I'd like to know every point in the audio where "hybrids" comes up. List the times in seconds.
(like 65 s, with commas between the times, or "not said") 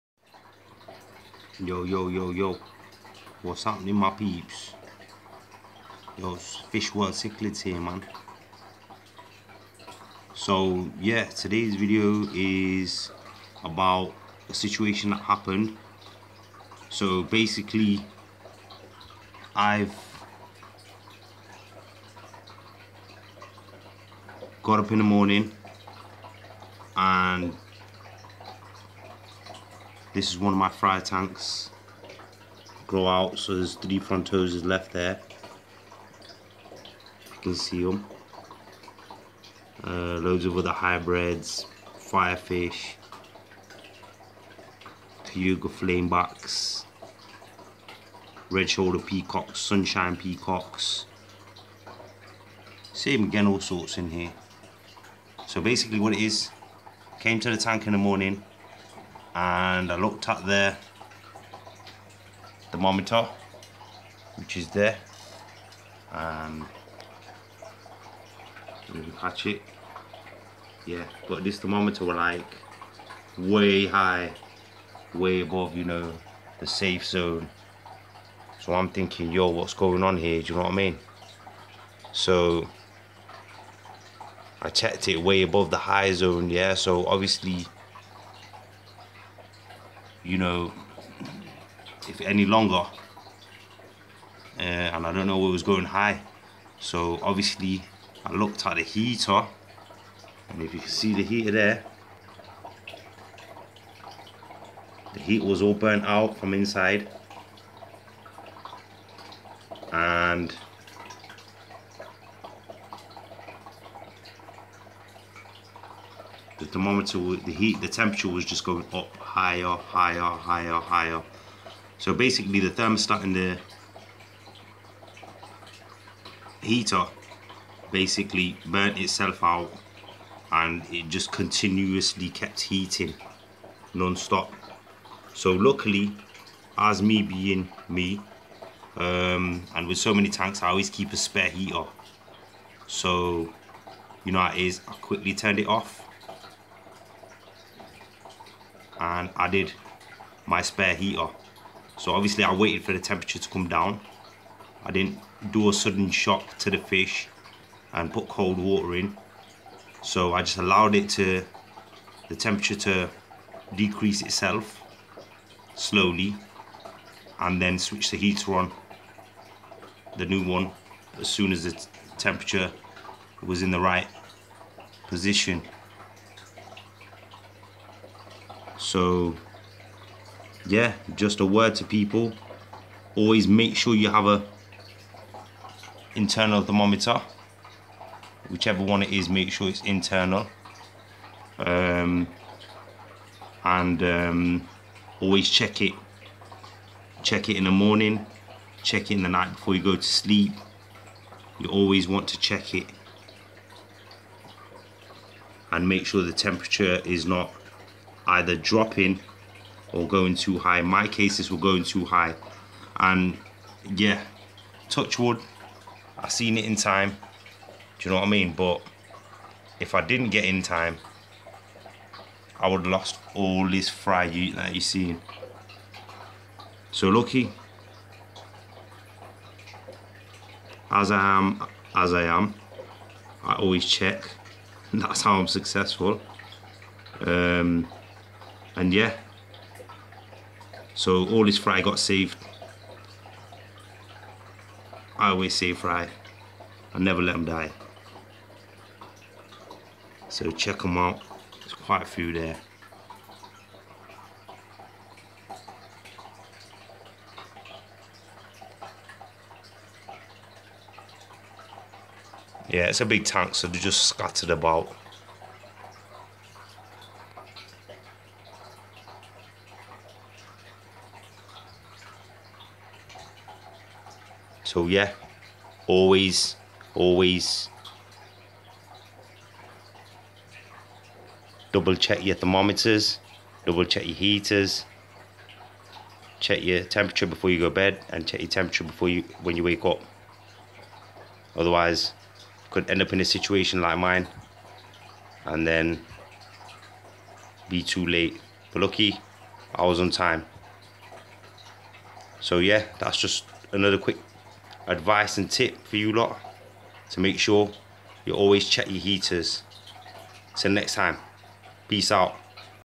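40 s.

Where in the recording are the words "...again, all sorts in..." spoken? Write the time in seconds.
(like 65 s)
53 s.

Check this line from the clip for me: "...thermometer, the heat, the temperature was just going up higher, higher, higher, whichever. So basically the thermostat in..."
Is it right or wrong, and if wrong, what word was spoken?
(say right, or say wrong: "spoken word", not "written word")
wrong: "higher", not "whichever".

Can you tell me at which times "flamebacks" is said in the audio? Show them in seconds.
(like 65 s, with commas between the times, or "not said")
45 s.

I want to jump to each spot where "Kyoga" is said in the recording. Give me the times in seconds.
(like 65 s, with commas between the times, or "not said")
45 s.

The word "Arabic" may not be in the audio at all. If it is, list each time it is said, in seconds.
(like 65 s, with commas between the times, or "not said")
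not said.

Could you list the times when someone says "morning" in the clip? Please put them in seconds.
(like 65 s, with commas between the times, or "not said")
25 s, 57 s, 197 s.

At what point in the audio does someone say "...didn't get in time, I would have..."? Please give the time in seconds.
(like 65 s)
220 s.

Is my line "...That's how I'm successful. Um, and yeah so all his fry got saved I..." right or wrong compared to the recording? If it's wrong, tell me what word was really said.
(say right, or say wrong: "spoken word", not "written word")
right.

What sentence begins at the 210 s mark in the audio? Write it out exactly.
my cases were going too high.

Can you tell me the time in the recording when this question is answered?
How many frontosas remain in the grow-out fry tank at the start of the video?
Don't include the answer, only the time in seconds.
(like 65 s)
33 s.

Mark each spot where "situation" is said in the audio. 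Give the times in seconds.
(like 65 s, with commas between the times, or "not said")
14 s, 293 s.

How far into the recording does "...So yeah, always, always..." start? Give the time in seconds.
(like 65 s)
274 s.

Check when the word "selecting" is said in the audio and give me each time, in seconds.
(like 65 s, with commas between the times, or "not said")
not said.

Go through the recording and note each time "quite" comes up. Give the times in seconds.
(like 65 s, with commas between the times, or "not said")
251 s.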